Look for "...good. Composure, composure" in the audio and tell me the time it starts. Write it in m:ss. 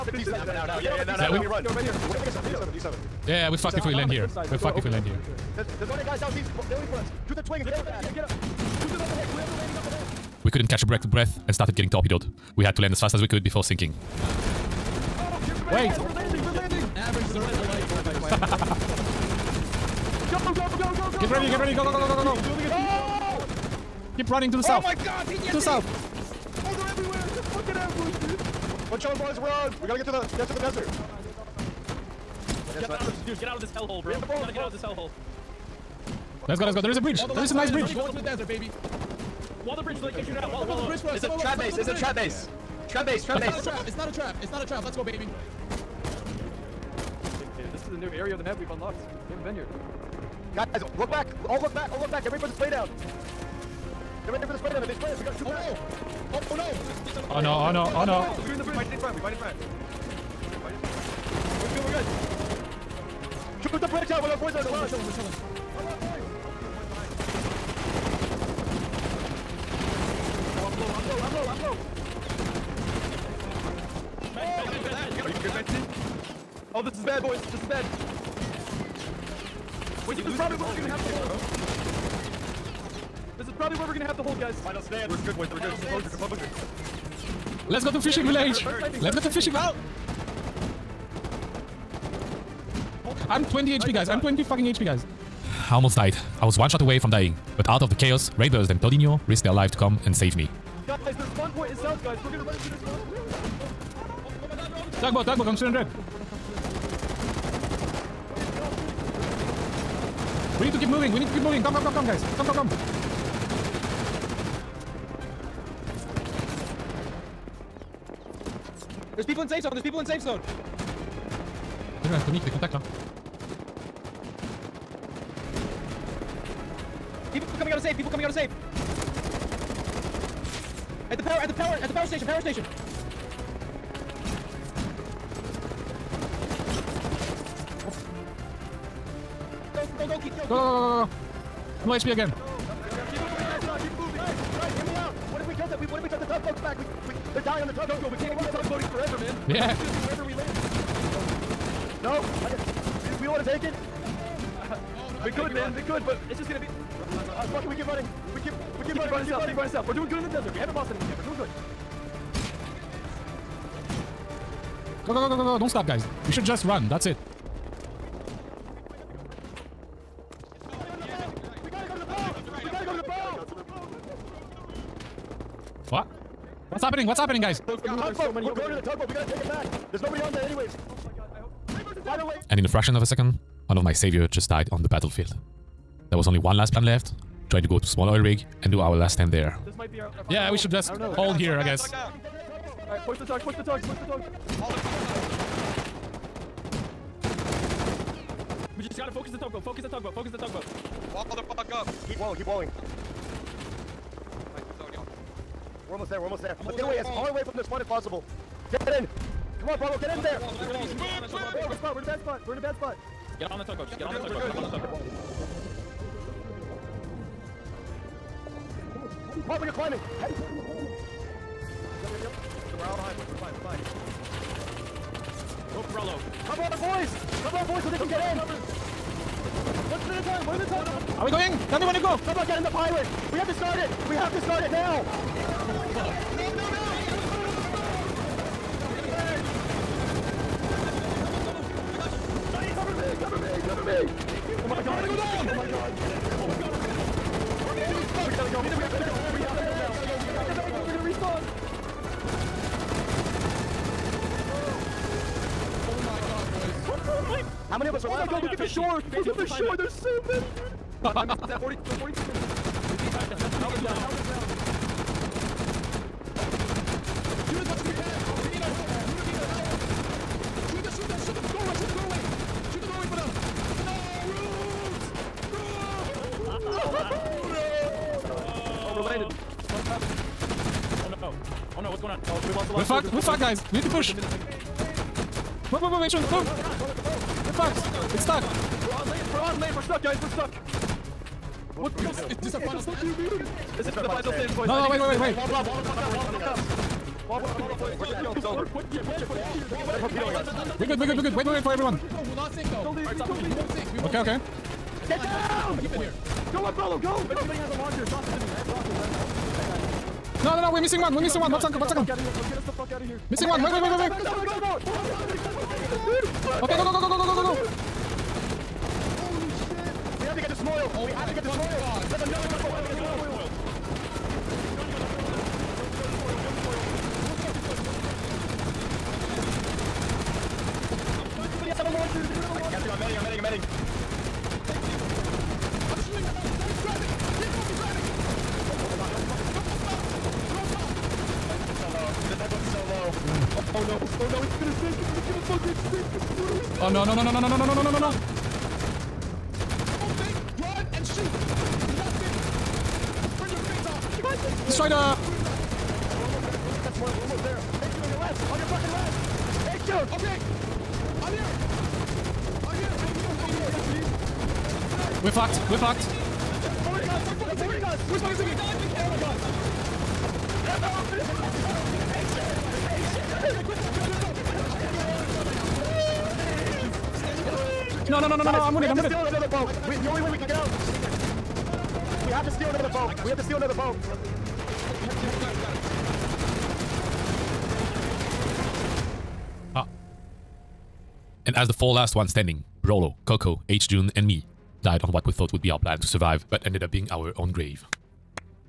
1:25.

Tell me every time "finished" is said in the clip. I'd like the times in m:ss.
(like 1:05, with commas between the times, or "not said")
not said.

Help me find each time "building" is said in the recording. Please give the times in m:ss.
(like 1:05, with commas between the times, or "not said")
0:06.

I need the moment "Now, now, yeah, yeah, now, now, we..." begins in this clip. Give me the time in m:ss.
0:00.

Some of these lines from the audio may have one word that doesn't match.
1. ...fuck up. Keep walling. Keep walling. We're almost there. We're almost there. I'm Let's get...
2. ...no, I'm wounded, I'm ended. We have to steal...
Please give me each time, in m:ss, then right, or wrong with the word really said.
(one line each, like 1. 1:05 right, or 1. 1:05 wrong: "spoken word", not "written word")
1. 3:21 right
2. 6:18 wrong: "wounded", not "ended".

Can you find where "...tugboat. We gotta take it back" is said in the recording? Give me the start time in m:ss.
2:58.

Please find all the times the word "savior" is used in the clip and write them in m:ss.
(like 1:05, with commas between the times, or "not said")
3:03.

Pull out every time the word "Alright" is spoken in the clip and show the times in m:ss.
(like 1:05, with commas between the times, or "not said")
3:11, 5:03.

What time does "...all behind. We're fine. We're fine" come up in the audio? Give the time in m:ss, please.
3:42.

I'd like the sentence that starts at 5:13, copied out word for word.
Missing one, wait, wait, wait, wait, wait.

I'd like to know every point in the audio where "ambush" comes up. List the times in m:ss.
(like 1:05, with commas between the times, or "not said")
0:28.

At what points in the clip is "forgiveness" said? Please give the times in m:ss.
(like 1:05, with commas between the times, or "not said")
not said.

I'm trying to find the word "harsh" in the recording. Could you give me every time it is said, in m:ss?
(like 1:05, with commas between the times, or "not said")
not said.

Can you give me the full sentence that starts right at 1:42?
We're gonna run into their spawn.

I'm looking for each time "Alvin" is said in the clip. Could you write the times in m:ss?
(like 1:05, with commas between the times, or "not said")
4:23.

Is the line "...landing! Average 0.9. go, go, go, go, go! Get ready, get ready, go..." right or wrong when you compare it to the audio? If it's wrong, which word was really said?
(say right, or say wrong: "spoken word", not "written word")
right.